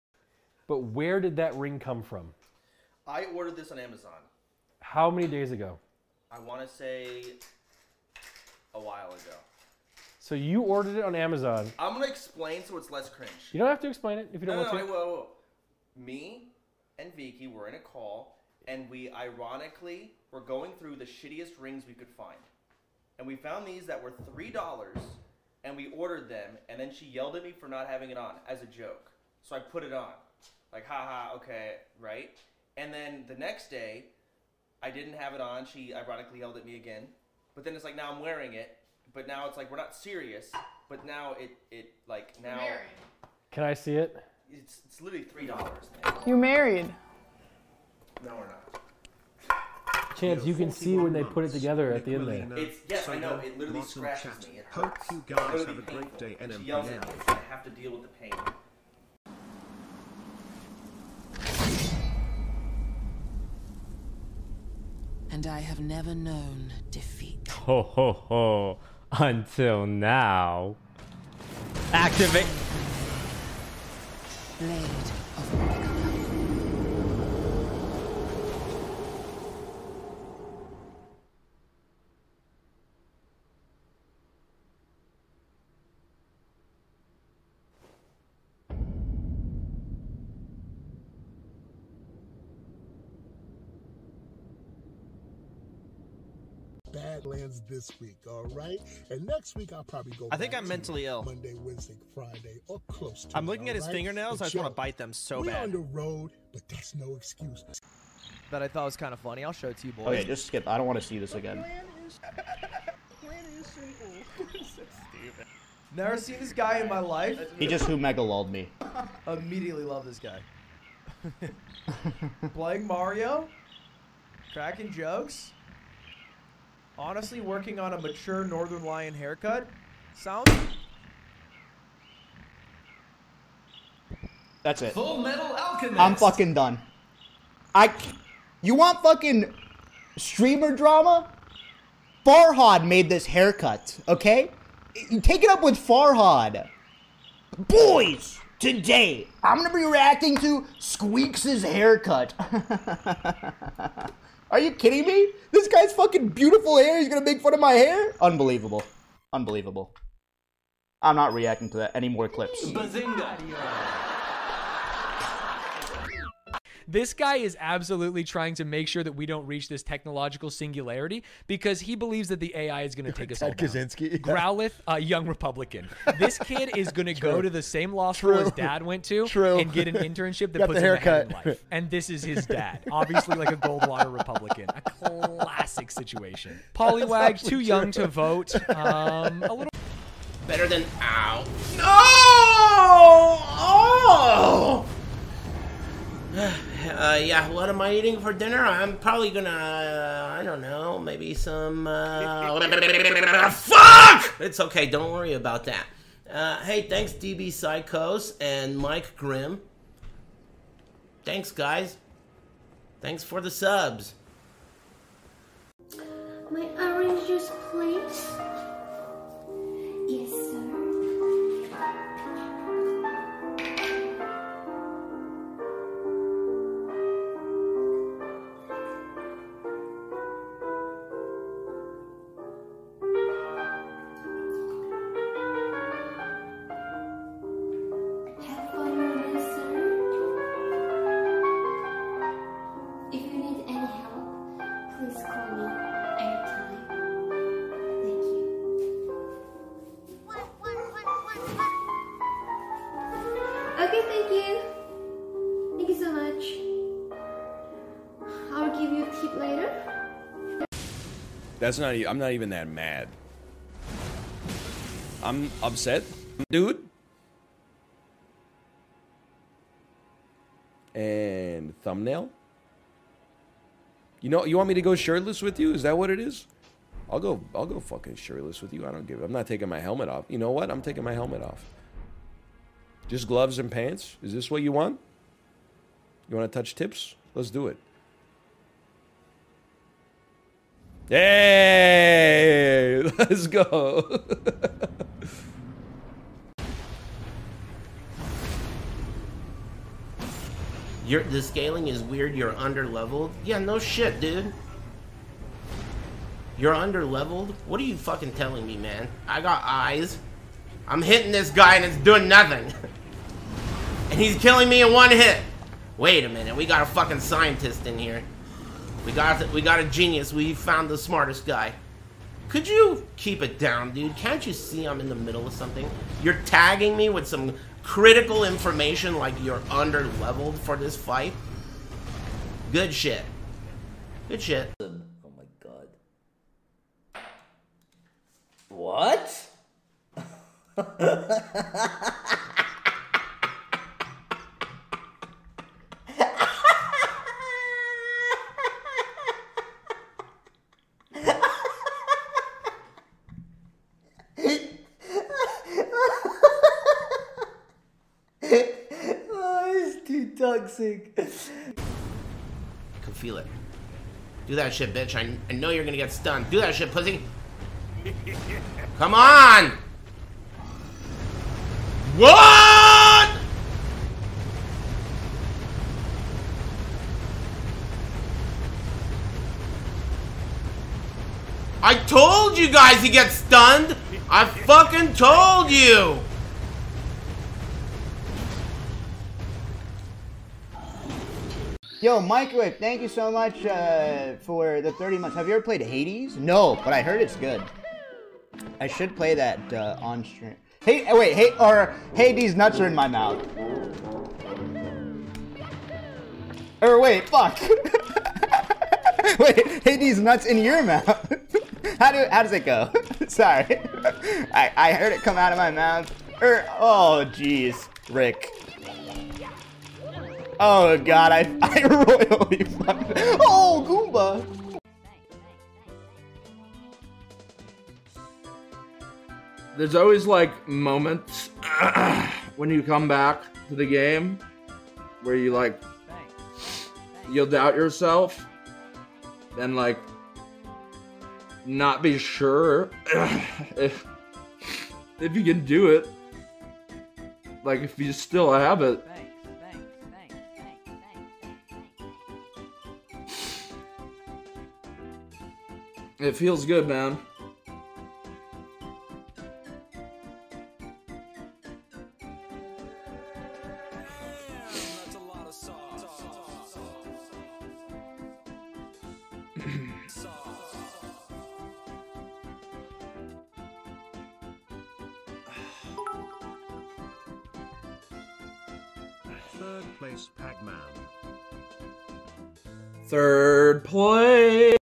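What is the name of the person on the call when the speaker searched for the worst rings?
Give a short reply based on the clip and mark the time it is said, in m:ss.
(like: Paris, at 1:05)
Vicky, at 0:17.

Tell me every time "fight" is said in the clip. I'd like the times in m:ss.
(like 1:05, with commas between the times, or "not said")
5:30.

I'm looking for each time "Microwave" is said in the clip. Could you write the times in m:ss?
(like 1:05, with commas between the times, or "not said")
6:32.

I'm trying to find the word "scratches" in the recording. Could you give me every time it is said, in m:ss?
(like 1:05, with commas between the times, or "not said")
0:53.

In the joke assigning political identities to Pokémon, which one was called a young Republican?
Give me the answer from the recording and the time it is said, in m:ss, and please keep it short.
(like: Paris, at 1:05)
Growlithe, at 2:54.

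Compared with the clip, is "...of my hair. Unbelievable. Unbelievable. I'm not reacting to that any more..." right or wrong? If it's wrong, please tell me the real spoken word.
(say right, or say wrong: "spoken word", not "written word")
right.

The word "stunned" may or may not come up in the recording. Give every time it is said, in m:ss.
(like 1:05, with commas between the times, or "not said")
6:06, 6:23.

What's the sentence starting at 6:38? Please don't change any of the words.
I should play that uh, on stream.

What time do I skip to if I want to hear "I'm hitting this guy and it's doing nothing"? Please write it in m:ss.
5:10.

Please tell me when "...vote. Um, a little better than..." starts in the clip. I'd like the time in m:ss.
3:08.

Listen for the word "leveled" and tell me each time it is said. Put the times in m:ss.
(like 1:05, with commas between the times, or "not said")
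5:02, 5:06, 5:30.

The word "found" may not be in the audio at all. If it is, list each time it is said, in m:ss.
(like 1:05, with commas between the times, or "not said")
0:23, 5:20.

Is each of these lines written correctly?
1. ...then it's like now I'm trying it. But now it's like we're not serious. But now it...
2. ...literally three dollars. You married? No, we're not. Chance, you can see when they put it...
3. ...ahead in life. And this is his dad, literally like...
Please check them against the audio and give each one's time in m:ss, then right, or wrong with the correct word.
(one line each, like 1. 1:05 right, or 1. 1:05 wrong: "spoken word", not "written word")
1. 0:37 wrong: "wearing", not "trying"
2. 0:45 right
3. 3:00 wrong: "obviously", not "literally".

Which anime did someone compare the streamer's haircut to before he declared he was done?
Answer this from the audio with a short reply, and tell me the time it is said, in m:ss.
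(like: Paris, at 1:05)
Full Metal Alchemist, at 2:14.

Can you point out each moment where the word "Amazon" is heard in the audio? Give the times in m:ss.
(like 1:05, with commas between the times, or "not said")
0:03, 0:11.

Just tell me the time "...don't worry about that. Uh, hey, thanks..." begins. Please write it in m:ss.
3:24.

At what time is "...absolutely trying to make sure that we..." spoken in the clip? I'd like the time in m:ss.
2:47.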